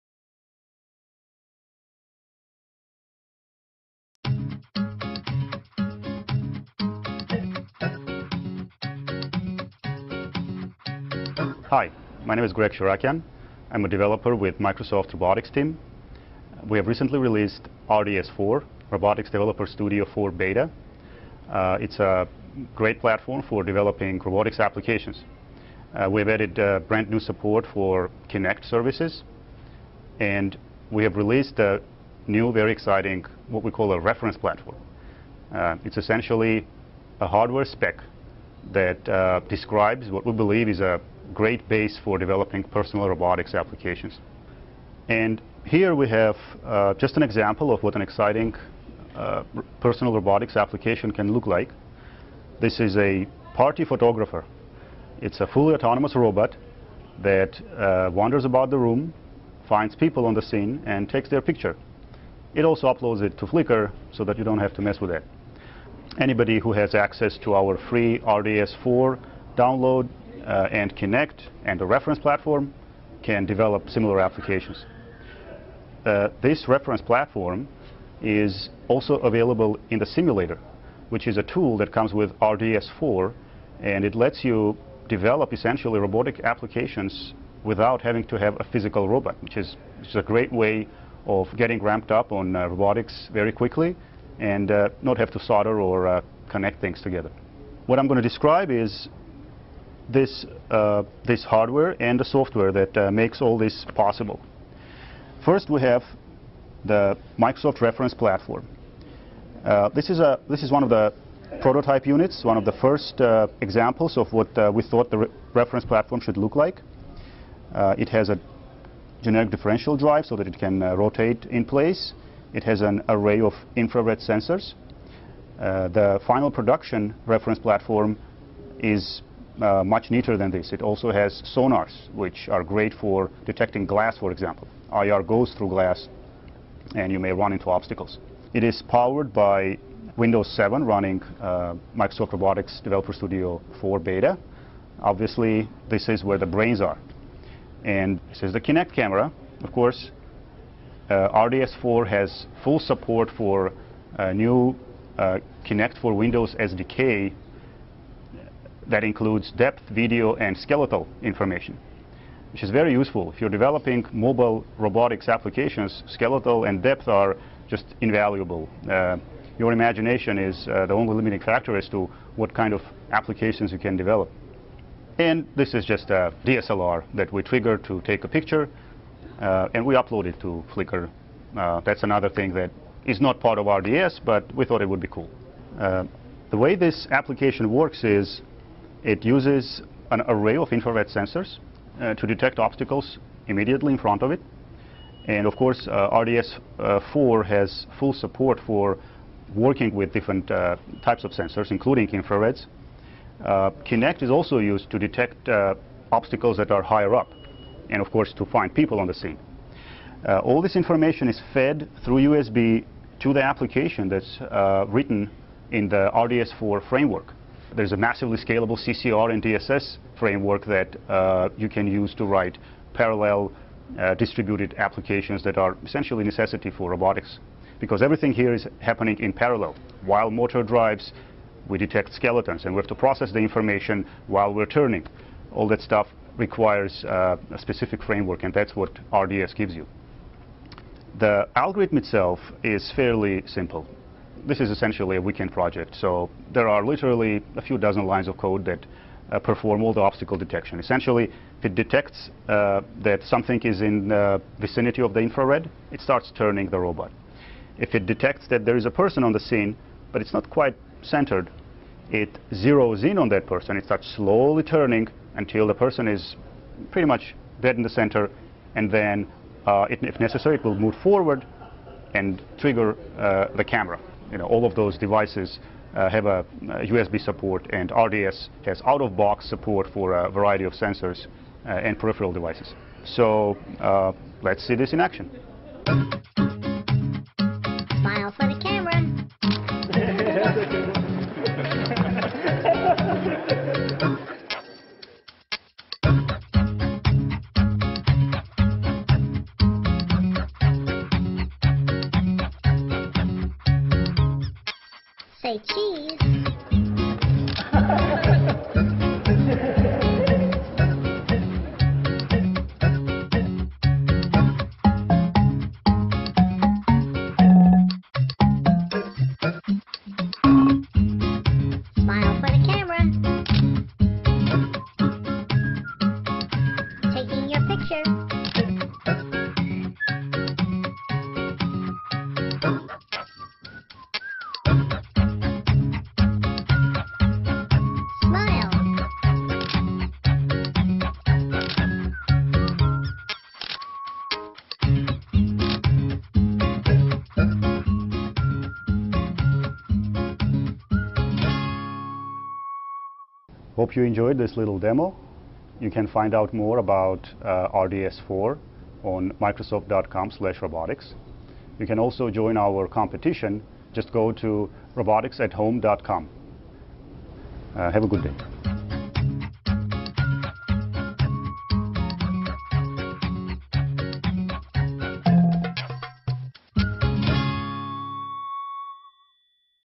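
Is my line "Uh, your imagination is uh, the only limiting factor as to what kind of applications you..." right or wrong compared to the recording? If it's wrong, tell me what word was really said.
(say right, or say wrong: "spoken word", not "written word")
right.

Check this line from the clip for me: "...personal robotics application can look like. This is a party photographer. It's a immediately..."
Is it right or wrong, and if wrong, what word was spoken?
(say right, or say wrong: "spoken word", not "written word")
wrong: "fully", not "immediately".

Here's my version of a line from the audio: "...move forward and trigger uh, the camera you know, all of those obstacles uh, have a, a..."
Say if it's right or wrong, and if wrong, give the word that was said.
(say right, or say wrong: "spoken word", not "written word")
wrong: "devices", not "obstacles".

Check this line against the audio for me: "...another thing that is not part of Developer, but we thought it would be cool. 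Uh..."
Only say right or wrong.
wrong.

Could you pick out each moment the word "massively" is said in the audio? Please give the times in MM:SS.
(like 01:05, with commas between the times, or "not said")
03:37.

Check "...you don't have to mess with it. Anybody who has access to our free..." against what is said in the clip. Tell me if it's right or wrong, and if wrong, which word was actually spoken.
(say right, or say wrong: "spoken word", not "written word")
right.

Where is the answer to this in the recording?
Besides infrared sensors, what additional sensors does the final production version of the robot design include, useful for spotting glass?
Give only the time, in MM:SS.
02:11.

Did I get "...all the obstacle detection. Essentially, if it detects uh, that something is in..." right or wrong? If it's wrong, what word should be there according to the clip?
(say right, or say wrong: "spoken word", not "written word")
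right.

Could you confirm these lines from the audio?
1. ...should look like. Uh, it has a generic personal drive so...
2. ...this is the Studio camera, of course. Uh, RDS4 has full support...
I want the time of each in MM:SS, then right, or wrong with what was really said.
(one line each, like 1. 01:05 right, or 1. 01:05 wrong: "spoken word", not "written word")
1. 01:56 wrong: "differential", not "personal"
2. 02:28 wrong: "Kinect", not "Studio".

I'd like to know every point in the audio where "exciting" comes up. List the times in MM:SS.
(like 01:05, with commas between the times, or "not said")
00:32, 00:48.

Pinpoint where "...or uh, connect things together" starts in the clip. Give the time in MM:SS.
01:35.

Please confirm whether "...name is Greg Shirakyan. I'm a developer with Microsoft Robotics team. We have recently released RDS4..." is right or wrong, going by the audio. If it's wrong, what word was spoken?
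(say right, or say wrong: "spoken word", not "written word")
right.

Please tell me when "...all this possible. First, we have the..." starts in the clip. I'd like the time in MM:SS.
01:43.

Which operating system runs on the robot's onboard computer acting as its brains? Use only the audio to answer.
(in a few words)
Windows 7.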